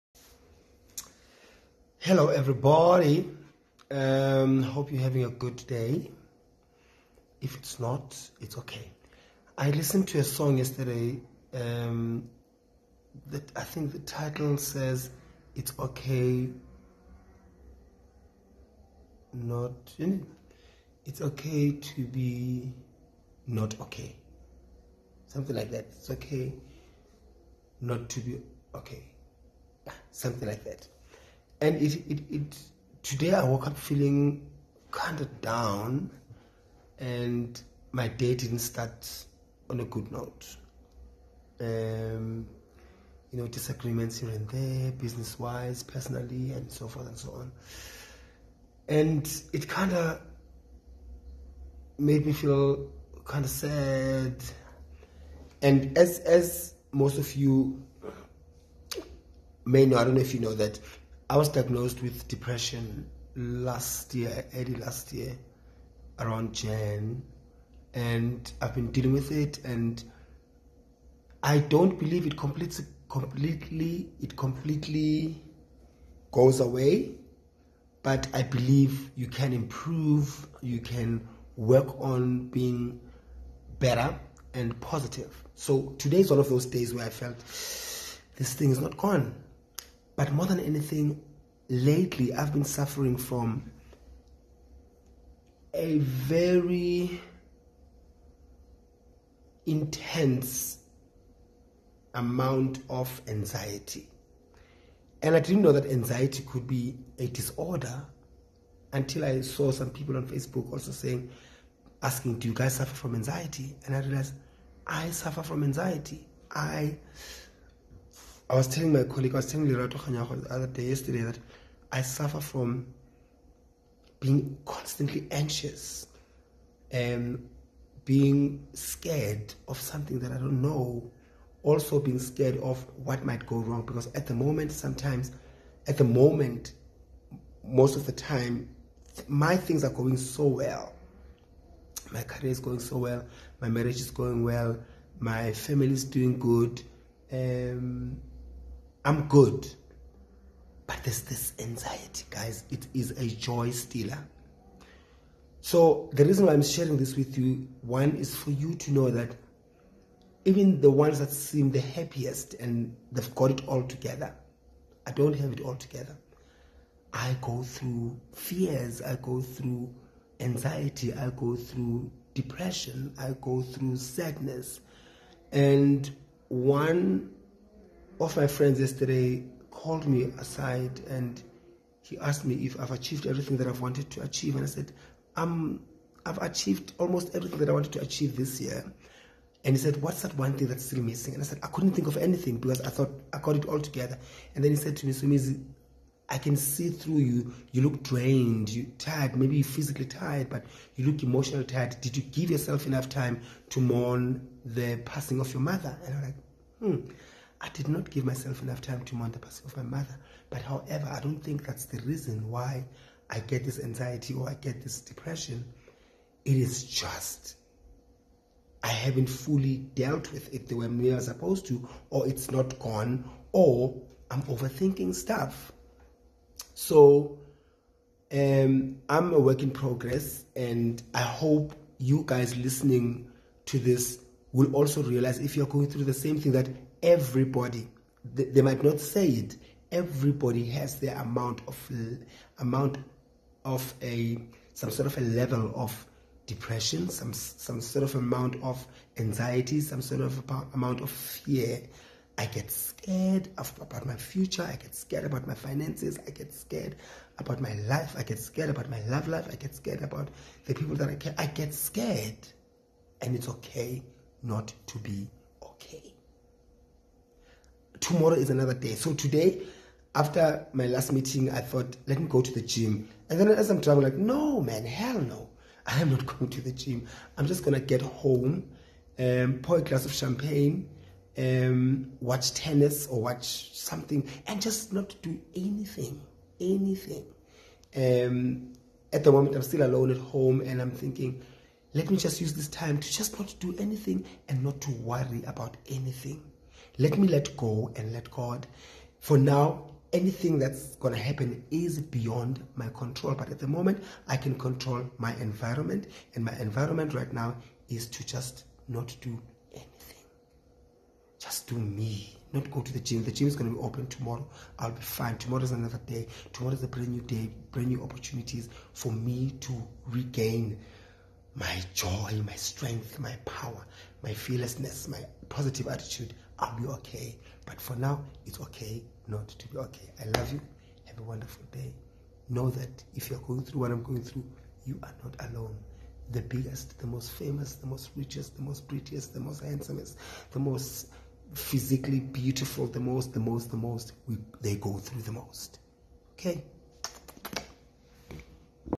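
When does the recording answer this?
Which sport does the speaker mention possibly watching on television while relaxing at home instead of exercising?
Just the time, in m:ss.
4:42.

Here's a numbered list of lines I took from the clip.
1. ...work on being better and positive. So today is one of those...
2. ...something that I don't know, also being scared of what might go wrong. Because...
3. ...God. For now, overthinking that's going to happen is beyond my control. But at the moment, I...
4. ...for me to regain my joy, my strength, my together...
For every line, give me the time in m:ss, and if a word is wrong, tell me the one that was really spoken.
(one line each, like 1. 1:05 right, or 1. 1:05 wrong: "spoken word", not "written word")
1. 1:21 right
2. 2:09 right
3. 4:58 wrong: "anything", not "overthinking"
4. 5:18 wrong: "power", not "together".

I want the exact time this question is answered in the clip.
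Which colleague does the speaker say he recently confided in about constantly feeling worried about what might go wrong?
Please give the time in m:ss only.
1:59.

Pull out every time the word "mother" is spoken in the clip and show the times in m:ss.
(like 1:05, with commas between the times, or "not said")
3:25, 3:29.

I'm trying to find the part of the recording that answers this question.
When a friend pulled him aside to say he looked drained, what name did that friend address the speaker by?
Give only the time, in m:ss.
3:15.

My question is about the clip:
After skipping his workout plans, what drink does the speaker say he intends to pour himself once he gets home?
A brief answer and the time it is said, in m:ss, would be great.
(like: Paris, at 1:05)
Champagne, at 4:40.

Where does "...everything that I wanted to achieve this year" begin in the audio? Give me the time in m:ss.
3:07.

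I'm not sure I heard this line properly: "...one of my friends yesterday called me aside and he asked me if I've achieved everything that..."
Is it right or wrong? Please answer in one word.
right.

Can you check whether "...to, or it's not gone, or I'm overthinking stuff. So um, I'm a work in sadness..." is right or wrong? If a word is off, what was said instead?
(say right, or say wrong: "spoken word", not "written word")
wrong: "progress", not "sadness".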